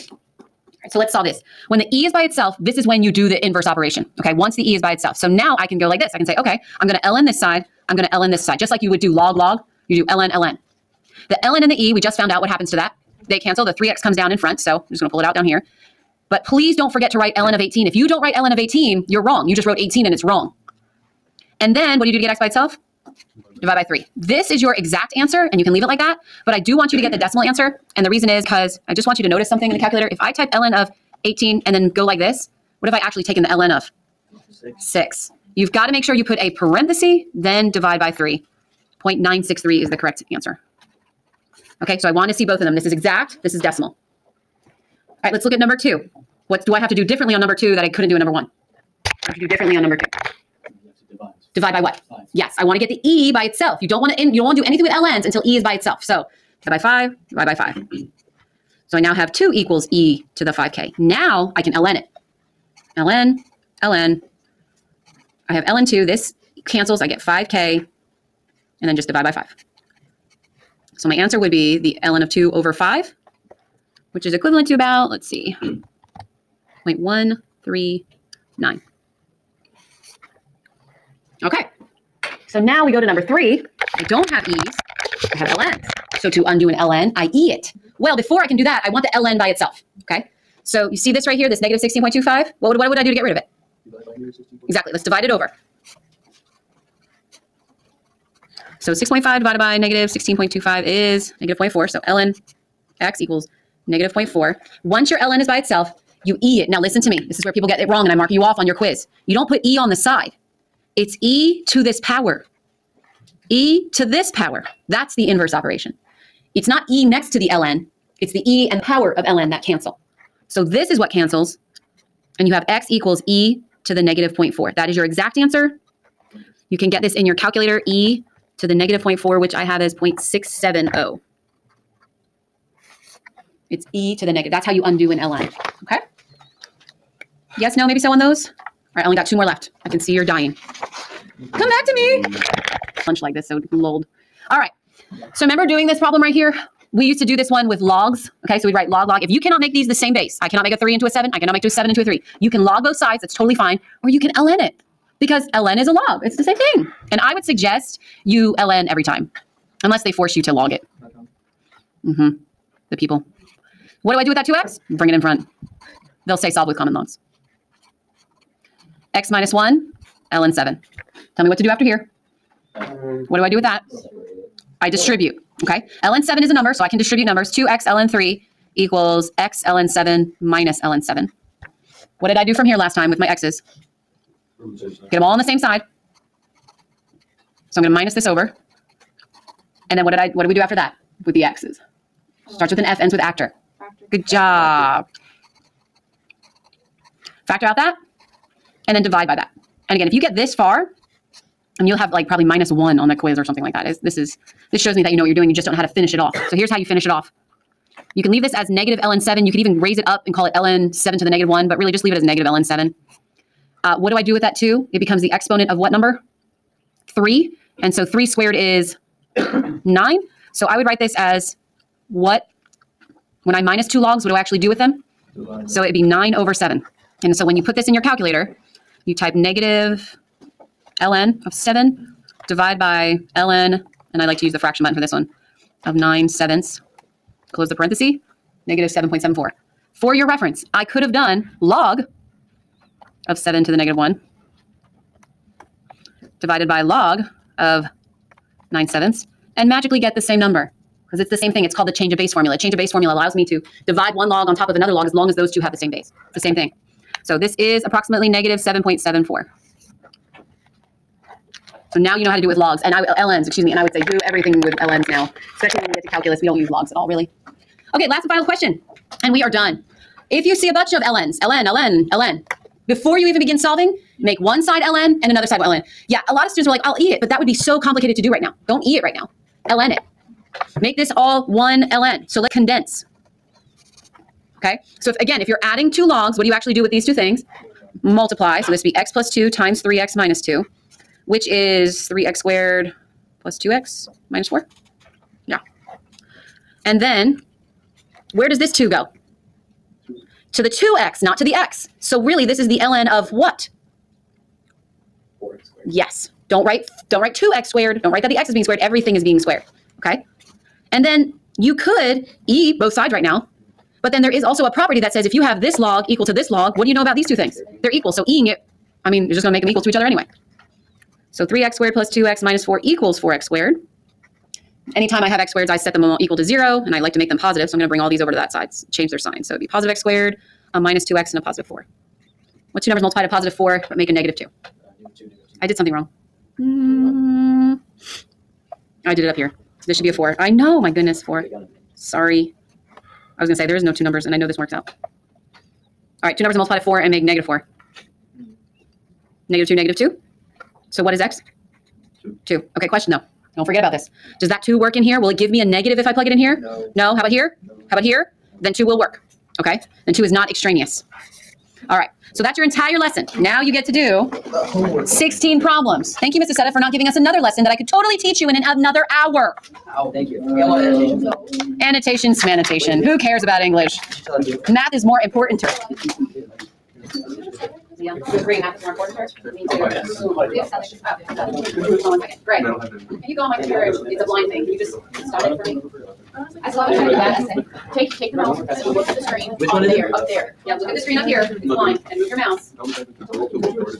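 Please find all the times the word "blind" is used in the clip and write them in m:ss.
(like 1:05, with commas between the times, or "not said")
6:24, 6:31.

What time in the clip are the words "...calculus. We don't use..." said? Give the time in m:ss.
4:26.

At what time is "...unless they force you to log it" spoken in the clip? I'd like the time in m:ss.
2:39.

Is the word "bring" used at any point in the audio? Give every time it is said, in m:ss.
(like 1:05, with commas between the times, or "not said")
2:44, 5:27.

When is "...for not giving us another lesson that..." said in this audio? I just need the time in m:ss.
6:06.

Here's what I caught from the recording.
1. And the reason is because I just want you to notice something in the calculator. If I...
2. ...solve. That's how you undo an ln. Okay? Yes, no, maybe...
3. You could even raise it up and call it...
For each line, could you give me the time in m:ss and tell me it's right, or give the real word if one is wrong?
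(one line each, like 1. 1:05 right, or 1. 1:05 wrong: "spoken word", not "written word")
1. 0:27 right
2. 2:14 wrong: "negative", not "solve"
3. 3:29 right.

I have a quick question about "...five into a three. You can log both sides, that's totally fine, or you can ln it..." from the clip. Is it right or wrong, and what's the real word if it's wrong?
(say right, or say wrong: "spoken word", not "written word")
wrong: "seven", not "five".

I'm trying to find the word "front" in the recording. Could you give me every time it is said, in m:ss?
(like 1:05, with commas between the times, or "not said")
0:14, 2:45.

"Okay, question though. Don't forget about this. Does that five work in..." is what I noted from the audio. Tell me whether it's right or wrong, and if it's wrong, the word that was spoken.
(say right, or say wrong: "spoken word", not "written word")
wrong: "two", not "five".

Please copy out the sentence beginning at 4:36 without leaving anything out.
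Yeah, a lot of students were like, I'll eat it, but that would be so complicated to do right now.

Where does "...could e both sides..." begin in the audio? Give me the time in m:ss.
5:11.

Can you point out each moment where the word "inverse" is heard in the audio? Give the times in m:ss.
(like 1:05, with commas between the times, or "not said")
0:03, 1:55.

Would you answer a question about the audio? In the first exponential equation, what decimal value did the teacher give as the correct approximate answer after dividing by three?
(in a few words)
0.963.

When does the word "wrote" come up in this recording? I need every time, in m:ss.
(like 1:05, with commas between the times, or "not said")
0:19.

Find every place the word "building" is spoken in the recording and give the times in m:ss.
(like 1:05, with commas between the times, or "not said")
not said.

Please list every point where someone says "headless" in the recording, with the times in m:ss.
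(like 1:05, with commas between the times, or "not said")
not said.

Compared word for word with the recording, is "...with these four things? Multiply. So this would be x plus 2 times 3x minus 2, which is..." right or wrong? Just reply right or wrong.
wrong.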